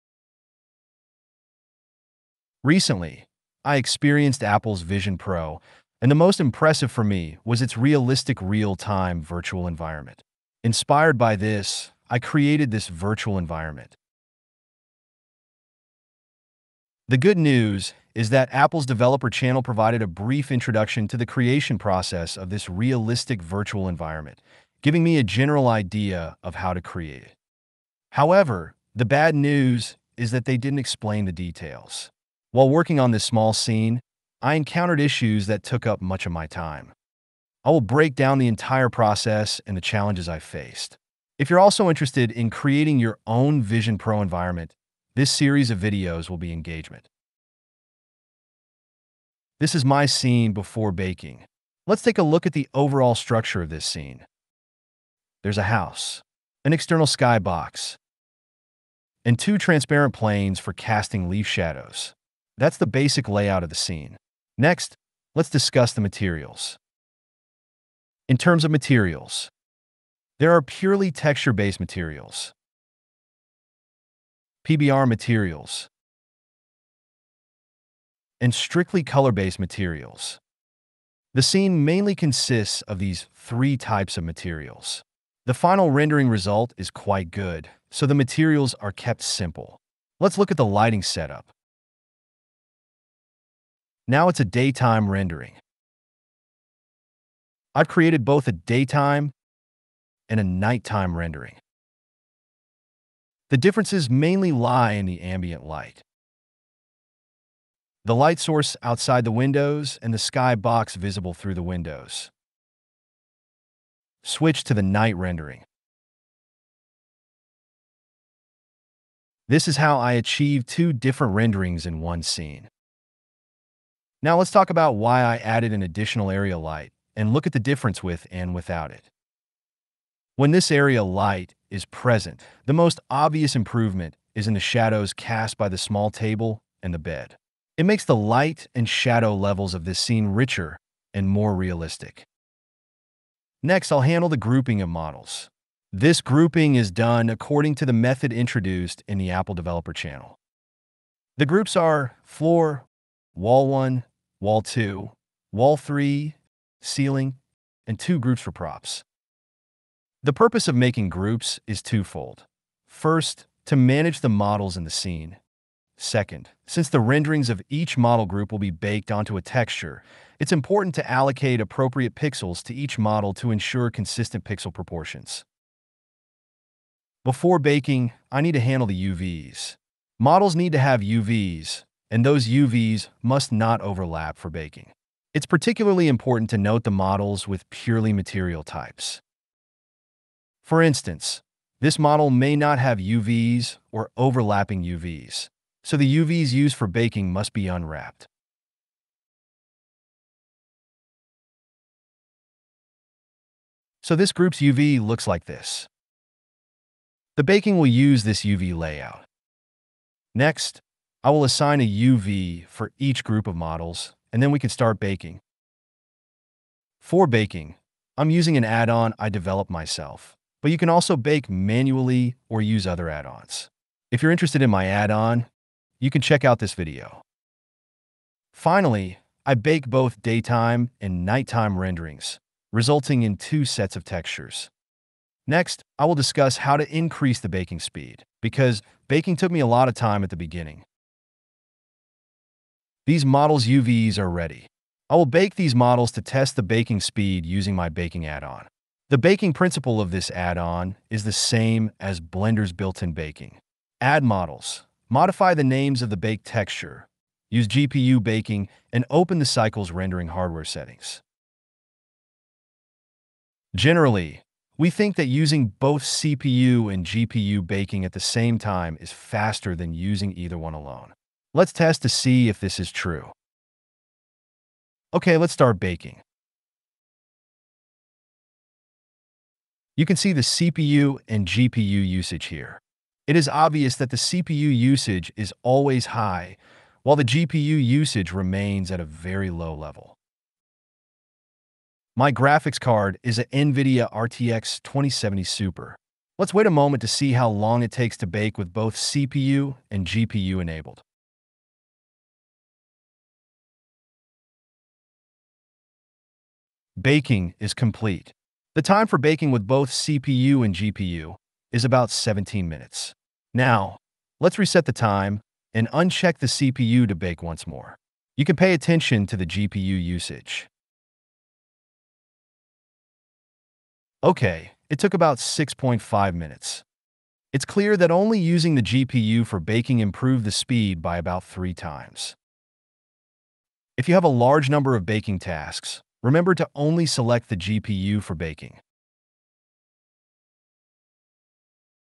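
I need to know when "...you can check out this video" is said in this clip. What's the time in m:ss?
3:45.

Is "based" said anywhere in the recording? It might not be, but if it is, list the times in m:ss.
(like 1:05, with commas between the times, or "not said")
1:11, 1:19.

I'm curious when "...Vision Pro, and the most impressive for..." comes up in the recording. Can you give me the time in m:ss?
0:04.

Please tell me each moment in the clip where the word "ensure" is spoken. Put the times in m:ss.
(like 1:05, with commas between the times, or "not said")
2:53.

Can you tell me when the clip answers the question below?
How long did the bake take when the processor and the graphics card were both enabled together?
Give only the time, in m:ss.
5:11.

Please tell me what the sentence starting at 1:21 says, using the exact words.
The scene mainly consists of these three types of materials.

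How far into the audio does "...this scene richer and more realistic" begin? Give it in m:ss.
2:19.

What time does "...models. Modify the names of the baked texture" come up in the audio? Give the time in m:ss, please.
4:14.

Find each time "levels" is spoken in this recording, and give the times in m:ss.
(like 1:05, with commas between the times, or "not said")
2:19, 4:49.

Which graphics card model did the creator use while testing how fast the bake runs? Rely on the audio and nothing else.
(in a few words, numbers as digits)
NVIDIA RTX 2070 Super.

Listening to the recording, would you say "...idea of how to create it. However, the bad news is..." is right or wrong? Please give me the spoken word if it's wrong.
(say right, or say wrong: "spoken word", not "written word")
right.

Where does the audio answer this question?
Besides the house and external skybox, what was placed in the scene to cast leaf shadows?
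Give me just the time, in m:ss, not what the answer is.
0:59.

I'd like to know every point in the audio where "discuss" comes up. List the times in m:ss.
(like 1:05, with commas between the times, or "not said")
1:05, 3:56.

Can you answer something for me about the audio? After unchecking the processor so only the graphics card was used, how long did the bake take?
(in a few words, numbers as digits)
About 6.5 minutes.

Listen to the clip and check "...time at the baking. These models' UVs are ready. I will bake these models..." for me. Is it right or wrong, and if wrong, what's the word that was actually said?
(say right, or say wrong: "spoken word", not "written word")
wrong: "beginning", not "baking".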